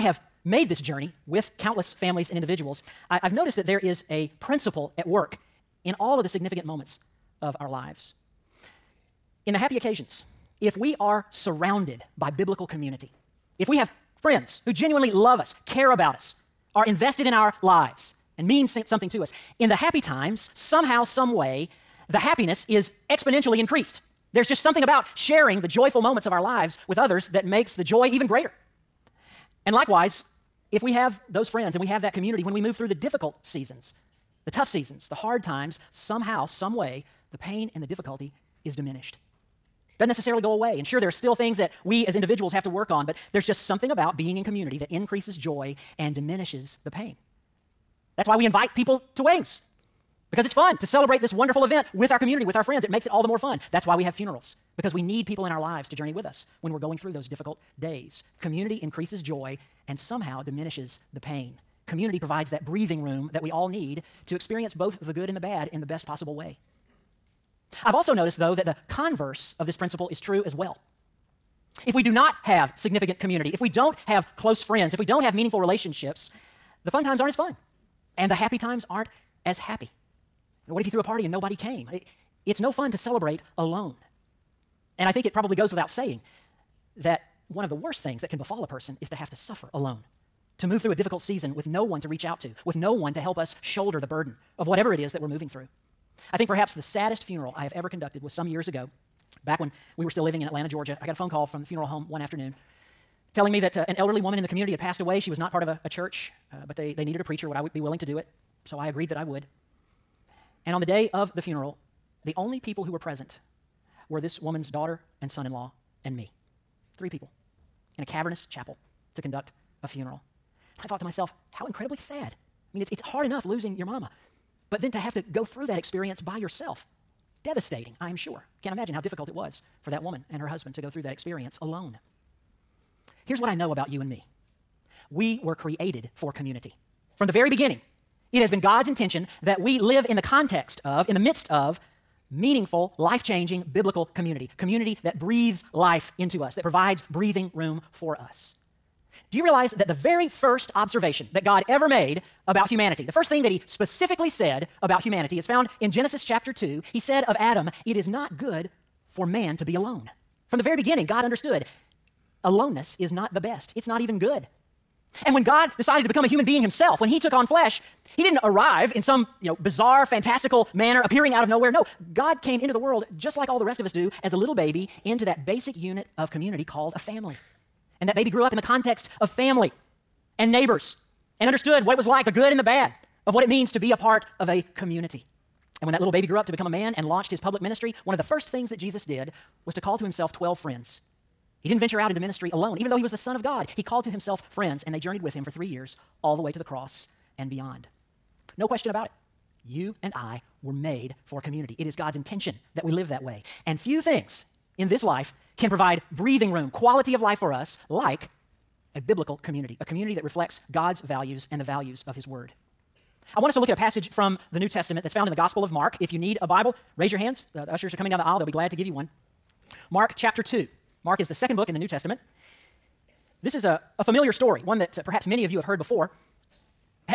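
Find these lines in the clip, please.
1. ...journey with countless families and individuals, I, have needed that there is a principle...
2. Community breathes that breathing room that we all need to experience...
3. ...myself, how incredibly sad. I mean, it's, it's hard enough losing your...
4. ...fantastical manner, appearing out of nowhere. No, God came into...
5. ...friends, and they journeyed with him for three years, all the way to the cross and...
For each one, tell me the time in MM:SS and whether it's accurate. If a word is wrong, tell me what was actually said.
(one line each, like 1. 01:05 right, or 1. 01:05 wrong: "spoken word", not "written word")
1. 00:00 wrong: "noticed", not "needed"
2. 01:01 wrong: "provides", not "breathes"
3. 02:01 right
4. 02:50 right
5. 03:14 right.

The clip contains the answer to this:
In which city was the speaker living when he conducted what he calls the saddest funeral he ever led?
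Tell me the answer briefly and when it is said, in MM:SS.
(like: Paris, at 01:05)
Atlanta, Georgia, at 01:40.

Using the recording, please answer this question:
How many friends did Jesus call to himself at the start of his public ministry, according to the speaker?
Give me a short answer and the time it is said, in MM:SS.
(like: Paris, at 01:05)
12, at 03:10.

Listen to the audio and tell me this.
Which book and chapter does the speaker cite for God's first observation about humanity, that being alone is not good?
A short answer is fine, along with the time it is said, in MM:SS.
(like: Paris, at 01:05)
Genesis chapter 2, at 02:35.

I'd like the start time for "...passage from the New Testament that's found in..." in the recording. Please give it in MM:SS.
03:33.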